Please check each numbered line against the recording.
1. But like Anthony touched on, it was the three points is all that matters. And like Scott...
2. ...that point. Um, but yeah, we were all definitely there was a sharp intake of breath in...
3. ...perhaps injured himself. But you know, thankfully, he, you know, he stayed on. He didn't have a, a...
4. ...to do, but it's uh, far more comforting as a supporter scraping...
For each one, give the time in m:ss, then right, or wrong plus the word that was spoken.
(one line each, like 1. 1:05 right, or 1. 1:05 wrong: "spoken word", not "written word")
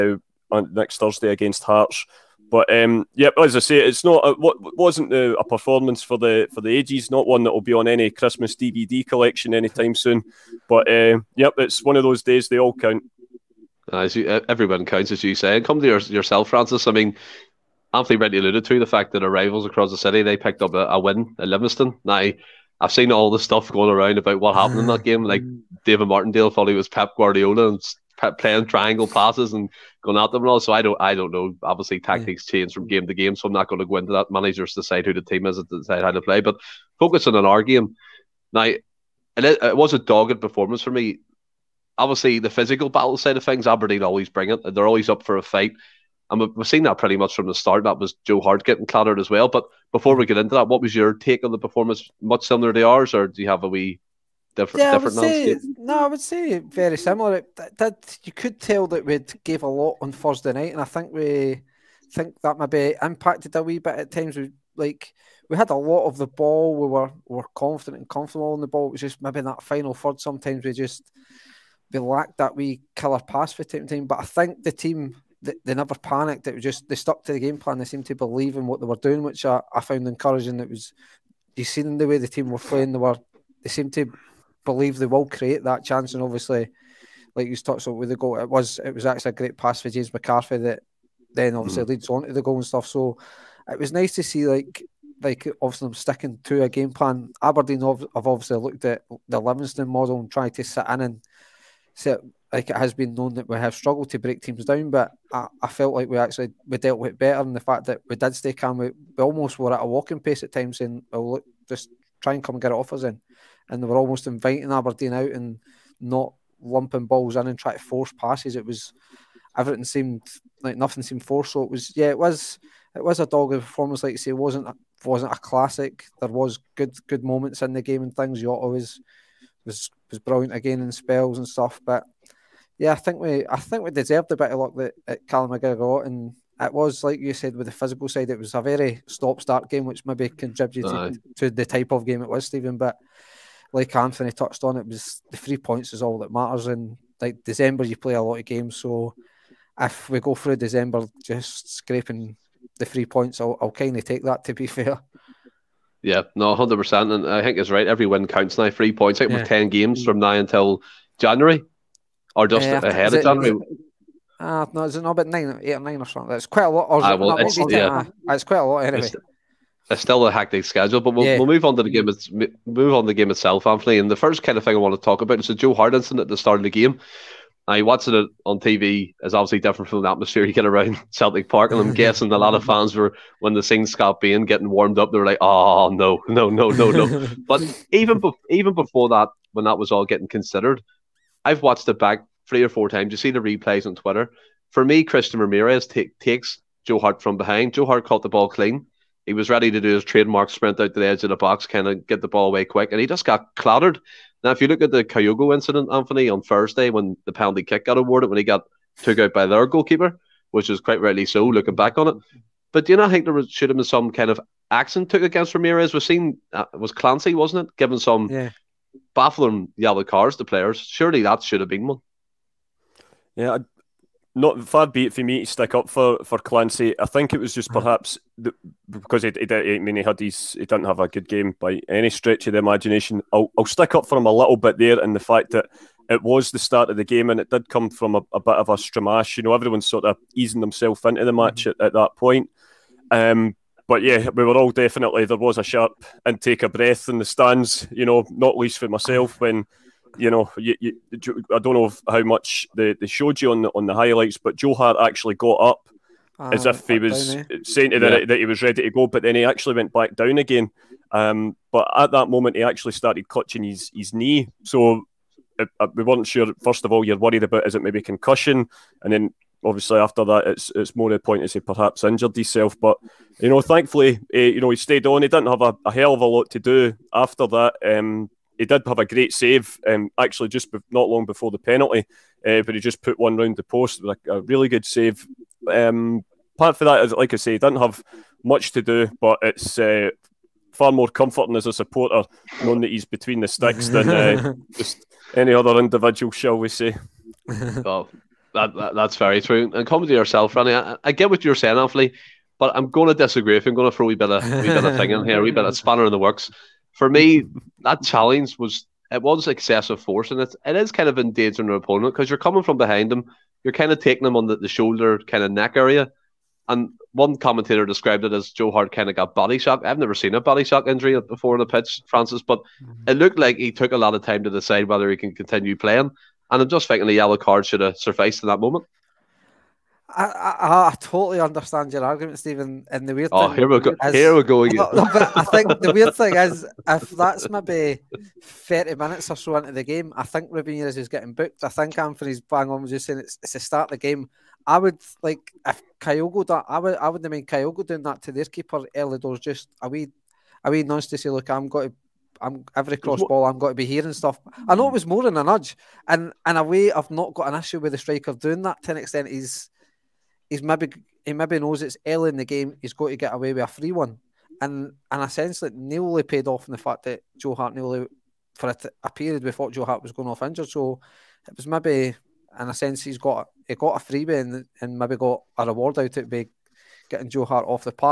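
1. 2:22 wrong: "December", not "Scott"
2. 4:01 right
3. 4:31 right
4. 4:48 wrong: "knowing", not "scraping".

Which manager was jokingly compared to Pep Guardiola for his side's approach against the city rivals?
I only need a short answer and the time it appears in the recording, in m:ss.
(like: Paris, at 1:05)
David Martindale, at 0:25.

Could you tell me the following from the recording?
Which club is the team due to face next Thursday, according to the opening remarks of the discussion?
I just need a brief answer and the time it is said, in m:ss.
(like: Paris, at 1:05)
Hearts, at 0:01.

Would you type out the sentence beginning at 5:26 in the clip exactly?
And I'm just thinking the yellow card should have sufficed in that moment.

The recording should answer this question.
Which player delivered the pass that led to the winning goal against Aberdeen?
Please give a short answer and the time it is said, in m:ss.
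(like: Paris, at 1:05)
James McCarthy, at 1:29.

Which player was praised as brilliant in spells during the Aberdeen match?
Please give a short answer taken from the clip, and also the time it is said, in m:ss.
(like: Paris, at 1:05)
Jota, at 2:08.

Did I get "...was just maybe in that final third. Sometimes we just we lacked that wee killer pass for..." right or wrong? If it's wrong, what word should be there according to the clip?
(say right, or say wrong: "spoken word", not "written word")
right.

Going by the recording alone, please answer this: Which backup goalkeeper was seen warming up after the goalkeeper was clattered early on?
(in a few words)
Scott Bain.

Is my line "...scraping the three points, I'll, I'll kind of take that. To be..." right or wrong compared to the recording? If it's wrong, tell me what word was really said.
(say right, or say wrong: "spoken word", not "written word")
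right.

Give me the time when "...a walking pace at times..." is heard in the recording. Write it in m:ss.
1:49.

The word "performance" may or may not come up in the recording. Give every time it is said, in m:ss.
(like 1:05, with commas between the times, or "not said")
0:05, 0:40, 0:51, 2:03.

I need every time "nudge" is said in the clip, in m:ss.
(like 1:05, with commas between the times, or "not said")
5:50, 5:55.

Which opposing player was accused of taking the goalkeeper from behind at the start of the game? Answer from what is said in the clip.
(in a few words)
Christian Ramirez.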